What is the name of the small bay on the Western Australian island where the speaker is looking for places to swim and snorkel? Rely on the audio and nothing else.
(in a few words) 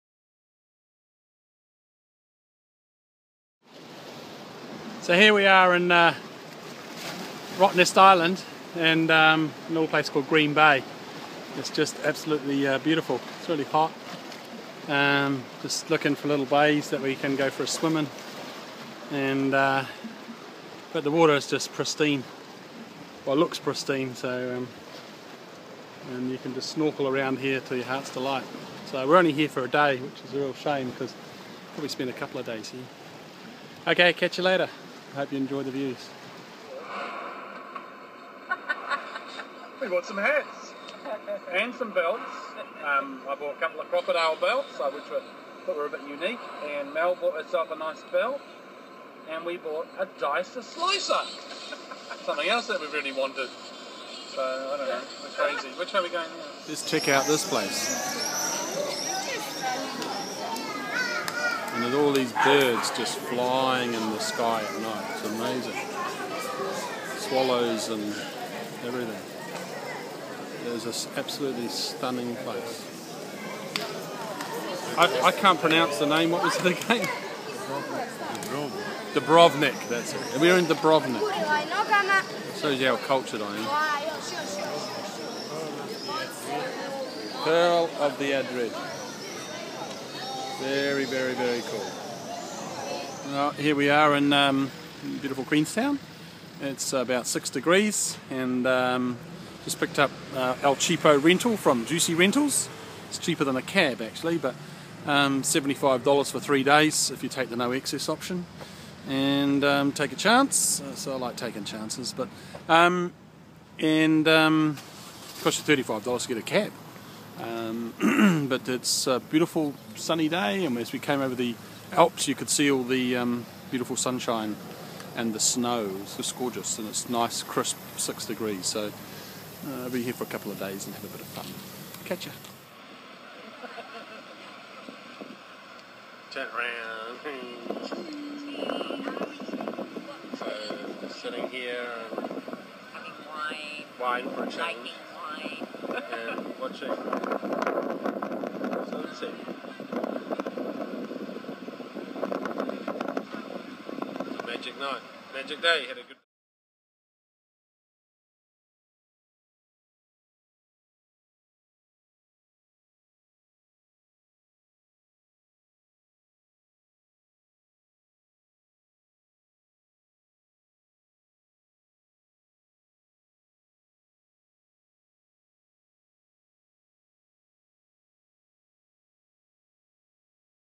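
Green Bay.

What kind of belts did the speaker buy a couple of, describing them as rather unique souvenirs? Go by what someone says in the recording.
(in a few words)
Crocodile belts.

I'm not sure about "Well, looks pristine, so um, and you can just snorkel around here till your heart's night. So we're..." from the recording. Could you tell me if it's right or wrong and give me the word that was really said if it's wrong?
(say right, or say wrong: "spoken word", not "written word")
wrong: "delight", not "night".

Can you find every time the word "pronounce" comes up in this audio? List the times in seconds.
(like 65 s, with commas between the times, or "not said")
75 s.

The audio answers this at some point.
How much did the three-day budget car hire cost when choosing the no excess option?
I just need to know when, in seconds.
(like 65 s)
105 s.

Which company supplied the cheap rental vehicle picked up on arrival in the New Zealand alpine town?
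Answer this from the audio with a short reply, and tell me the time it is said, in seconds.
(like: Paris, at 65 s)
Jucy Rentals, at 101 s.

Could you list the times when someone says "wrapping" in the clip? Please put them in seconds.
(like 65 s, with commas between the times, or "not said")
not said.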